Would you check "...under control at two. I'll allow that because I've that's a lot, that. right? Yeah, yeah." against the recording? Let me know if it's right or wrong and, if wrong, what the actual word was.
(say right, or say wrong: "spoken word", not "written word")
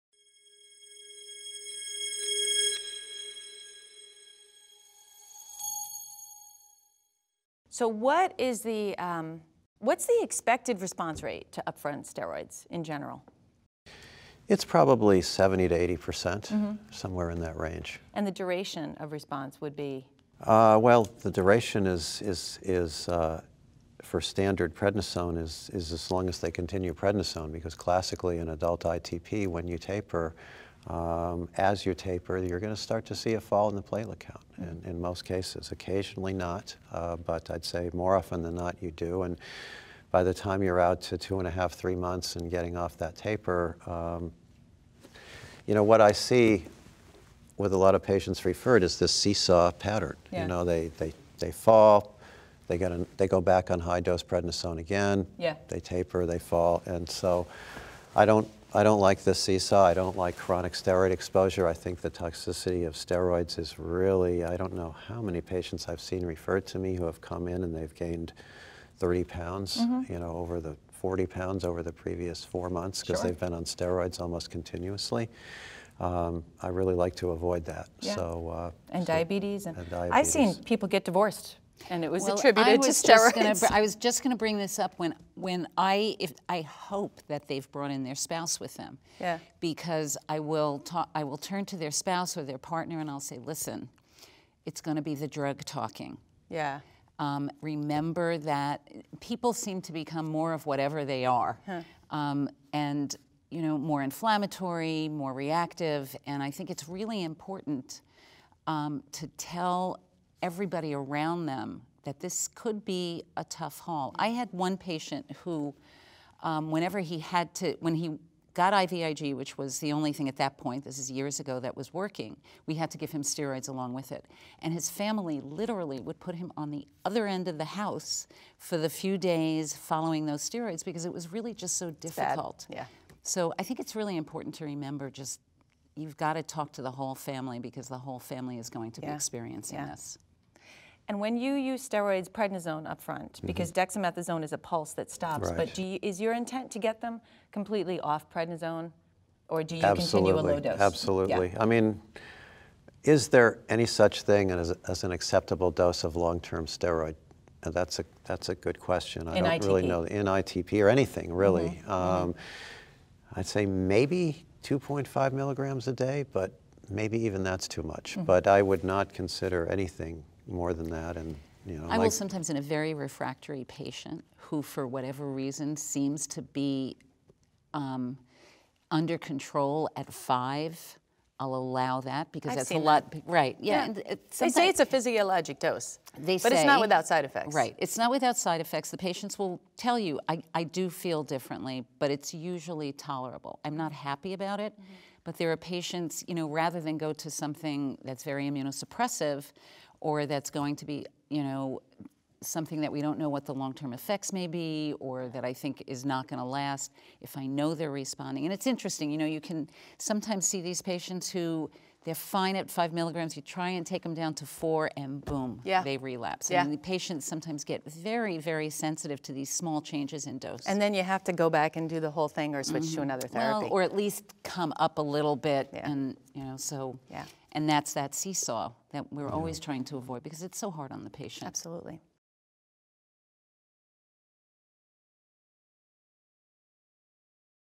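wrong: "five", not "two".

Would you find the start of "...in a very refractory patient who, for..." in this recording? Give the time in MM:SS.
02:52.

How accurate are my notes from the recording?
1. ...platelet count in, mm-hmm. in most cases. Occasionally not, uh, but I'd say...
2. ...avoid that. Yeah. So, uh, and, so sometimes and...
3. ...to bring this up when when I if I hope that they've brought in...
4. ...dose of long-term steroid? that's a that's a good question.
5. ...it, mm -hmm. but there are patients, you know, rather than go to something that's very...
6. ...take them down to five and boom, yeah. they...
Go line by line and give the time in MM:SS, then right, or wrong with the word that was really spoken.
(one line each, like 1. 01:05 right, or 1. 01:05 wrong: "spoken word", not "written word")
1. 00:33 right
2. 01:17 wrong: "diabetes", not "sometimes"
3. 01:24 right
4. 02:35 right
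5. 03:14 right
6. 03:33 wrong: "four", not "five".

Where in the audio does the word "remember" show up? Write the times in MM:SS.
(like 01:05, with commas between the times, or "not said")
01:37, 02:14.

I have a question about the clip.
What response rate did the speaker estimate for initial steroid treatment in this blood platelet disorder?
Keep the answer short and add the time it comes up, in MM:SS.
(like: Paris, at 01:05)
70 to 80 percent, at 00:15.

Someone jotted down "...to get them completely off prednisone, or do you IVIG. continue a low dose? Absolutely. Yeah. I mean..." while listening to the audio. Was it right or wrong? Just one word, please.
wrong.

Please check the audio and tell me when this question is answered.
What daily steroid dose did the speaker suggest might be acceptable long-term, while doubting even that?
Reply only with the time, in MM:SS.
02:44.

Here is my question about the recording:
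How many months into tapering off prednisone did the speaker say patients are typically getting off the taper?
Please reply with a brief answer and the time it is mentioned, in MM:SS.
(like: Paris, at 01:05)
2.5 to 3 months, at 00:41.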